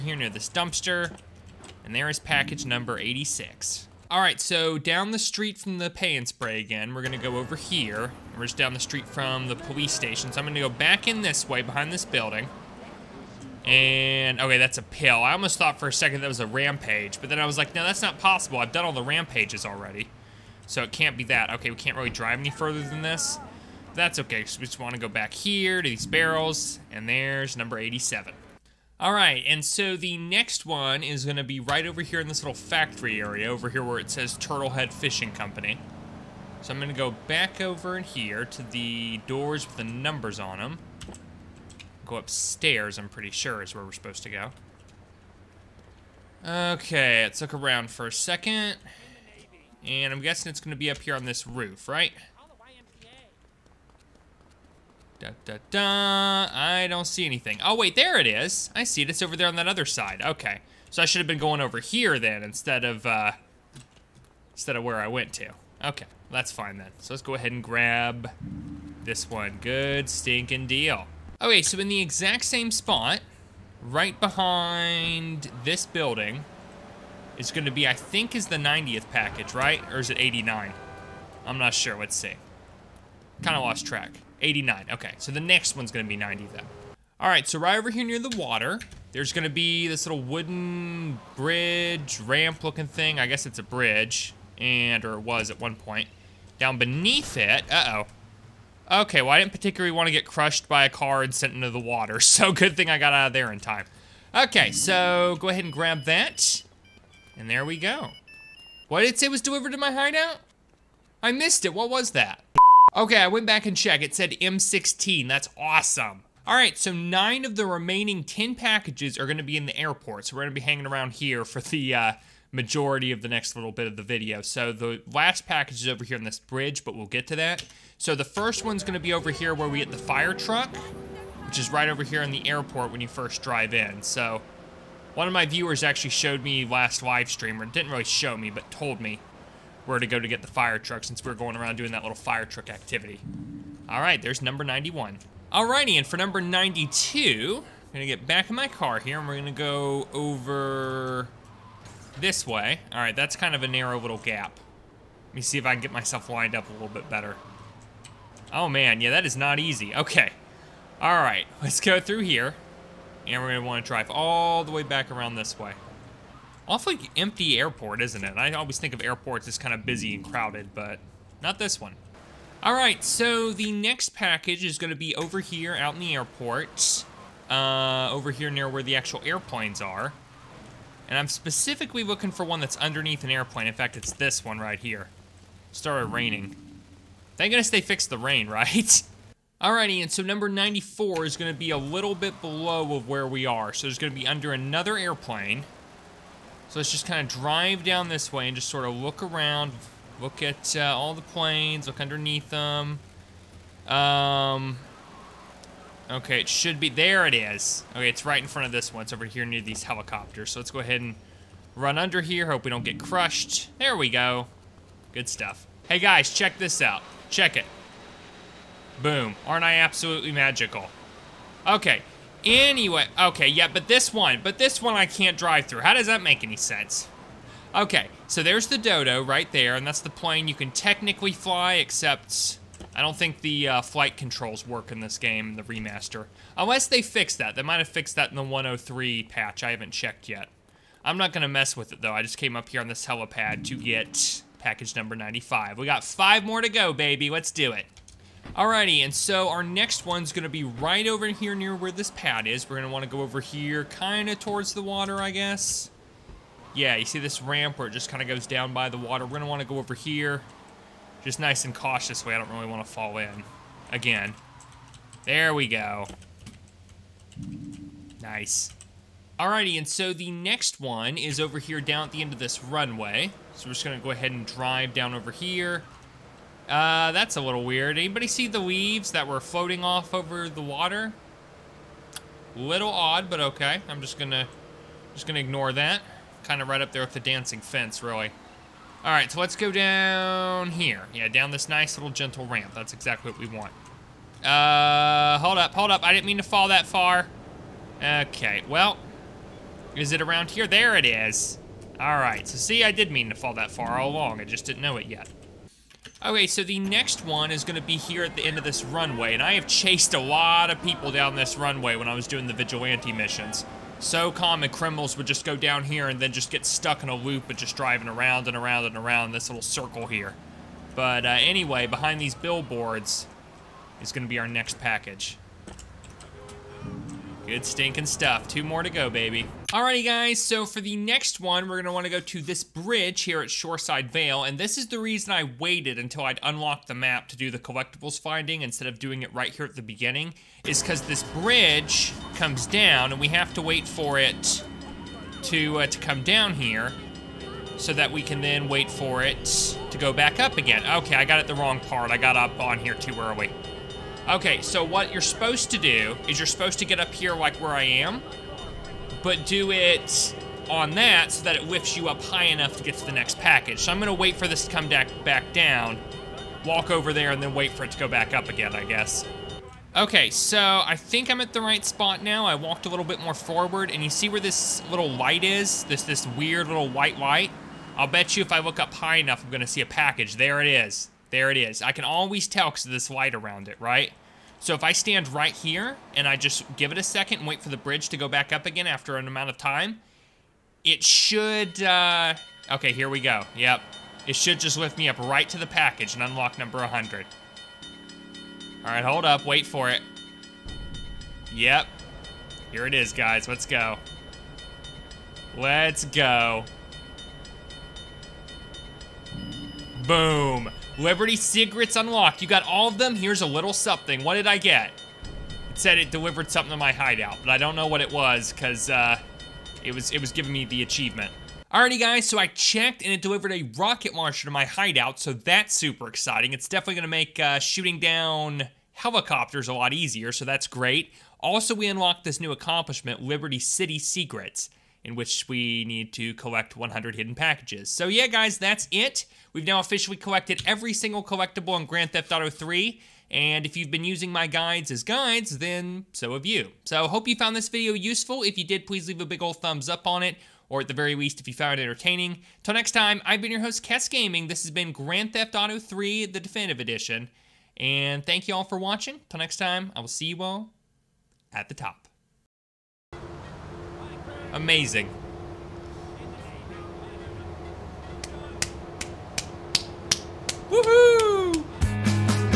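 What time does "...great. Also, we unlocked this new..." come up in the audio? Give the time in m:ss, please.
7:10.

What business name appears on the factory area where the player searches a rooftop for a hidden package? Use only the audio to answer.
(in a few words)
Turtlehead Fishing Company.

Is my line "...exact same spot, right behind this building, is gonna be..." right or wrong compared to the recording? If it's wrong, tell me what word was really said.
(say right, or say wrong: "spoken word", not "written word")
right.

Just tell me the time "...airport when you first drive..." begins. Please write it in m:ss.
2:12.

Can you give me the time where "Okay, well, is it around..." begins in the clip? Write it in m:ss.
4:58.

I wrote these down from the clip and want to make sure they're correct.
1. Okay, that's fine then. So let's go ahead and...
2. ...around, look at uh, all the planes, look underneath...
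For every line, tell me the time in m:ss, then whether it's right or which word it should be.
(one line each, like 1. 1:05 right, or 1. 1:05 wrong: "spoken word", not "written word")
1. 1:05 right
2. 3:19 right.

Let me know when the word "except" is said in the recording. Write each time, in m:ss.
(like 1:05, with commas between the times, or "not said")
3:51.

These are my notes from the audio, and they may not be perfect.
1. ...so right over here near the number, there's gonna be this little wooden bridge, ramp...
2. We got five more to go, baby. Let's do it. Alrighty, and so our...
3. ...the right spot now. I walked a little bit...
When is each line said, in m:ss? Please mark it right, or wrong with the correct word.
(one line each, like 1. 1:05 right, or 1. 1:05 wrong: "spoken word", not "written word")
1. 1:27 wrong: "water", not "number"
2. 4:05 right
3. 6:11 right.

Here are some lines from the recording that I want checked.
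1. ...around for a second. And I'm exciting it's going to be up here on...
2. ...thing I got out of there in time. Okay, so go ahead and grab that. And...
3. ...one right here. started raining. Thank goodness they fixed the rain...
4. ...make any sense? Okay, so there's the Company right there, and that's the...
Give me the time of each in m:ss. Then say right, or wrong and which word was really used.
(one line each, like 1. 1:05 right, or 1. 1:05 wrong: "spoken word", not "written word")
1. 0:47 wrong: "guessing", not "exciting"
2. 1:42 right
3. 3:04 right
4. 3:46 wrong: "Dodo", not "Company".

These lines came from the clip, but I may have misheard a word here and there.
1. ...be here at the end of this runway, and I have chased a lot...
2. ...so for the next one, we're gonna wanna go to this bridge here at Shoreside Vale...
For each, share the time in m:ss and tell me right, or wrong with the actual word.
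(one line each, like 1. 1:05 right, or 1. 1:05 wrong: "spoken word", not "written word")
1. 5:07 right
2. 5:30 right.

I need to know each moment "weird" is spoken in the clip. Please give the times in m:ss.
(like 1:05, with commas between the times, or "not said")
4:37, 6:16.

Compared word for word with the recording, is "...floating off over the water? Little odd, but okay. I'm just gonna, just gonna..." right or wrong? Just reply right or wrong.
right.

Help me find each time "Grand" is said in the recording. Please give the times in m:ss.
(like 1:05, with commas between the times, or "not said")
7:21, 7:34.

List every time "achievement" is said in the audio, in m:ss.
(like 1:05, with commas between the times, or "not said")
7:00.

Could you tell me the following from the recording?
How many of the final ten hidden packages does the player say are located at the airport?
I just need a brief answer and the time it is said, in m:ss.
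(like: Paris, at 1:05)
9, at 1:56.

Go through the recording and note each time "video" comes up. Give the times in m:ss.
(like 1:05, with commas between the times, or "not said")
2:04, 7:27.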